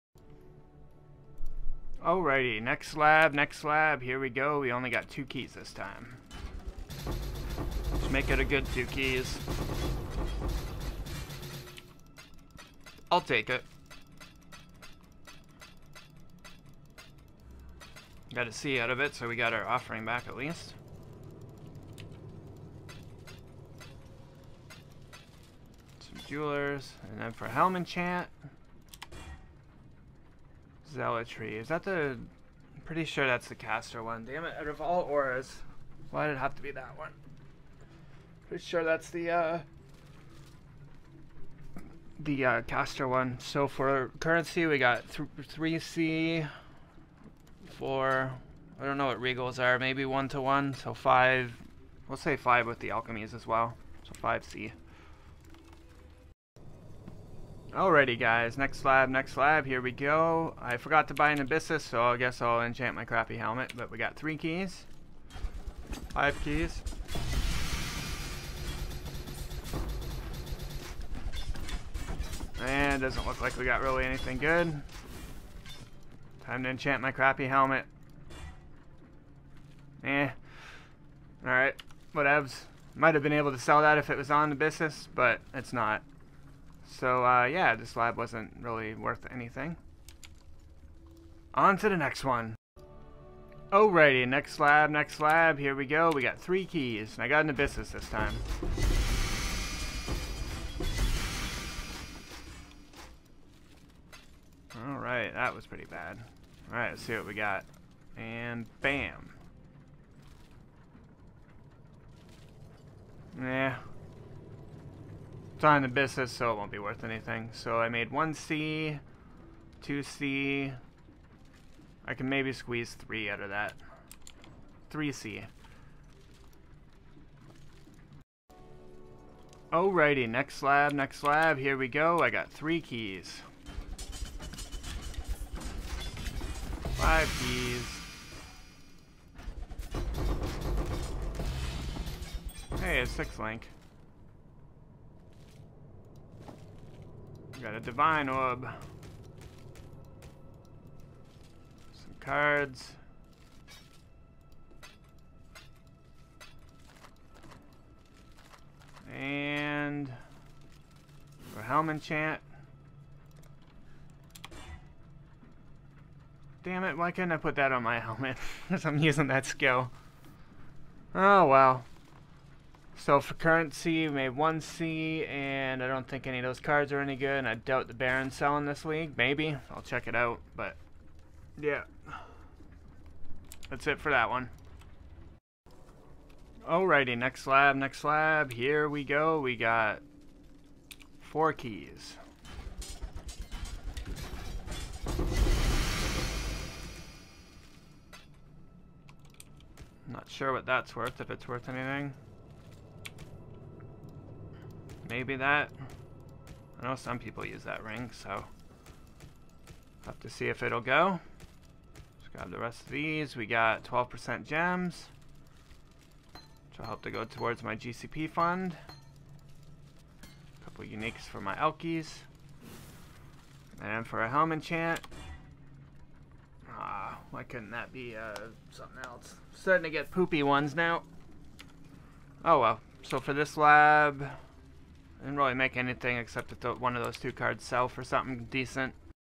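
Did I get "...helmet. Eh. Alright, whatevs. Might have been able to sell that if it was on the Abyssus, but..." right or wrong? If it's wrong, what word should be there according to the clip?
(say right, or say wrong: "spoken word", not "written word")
right.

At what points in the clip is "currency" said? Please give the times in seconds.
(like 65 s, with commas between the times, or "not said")
44 s, 173 s.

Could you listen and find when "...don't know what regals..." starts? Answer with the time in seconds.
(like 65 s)
48 s.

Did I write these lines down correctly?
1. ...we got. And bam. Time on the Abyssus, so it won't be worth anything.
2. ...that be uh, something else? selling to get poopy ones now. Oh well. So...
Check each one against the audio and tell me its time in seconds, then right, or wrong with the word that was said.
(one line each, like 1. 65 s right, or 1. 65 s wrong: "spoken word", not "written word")
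1. 107 s right
2. 227 s wrong: "starting", not "selling".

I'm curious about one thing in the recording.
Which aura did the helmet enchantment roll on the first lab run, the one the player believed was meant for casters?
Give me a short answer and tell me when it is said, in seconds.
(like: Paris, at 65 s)
Zealotry, at 30 s.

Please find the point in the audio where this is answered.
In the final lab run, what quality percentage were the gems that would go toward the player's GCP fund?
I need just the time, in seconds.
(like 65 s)
213 s.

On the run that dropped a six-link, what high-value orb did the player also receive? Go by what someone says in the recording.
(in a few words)
Divine orb.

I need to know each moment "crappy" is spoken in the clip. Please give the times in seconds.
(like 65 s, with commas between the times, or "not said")
63 s, 77 s.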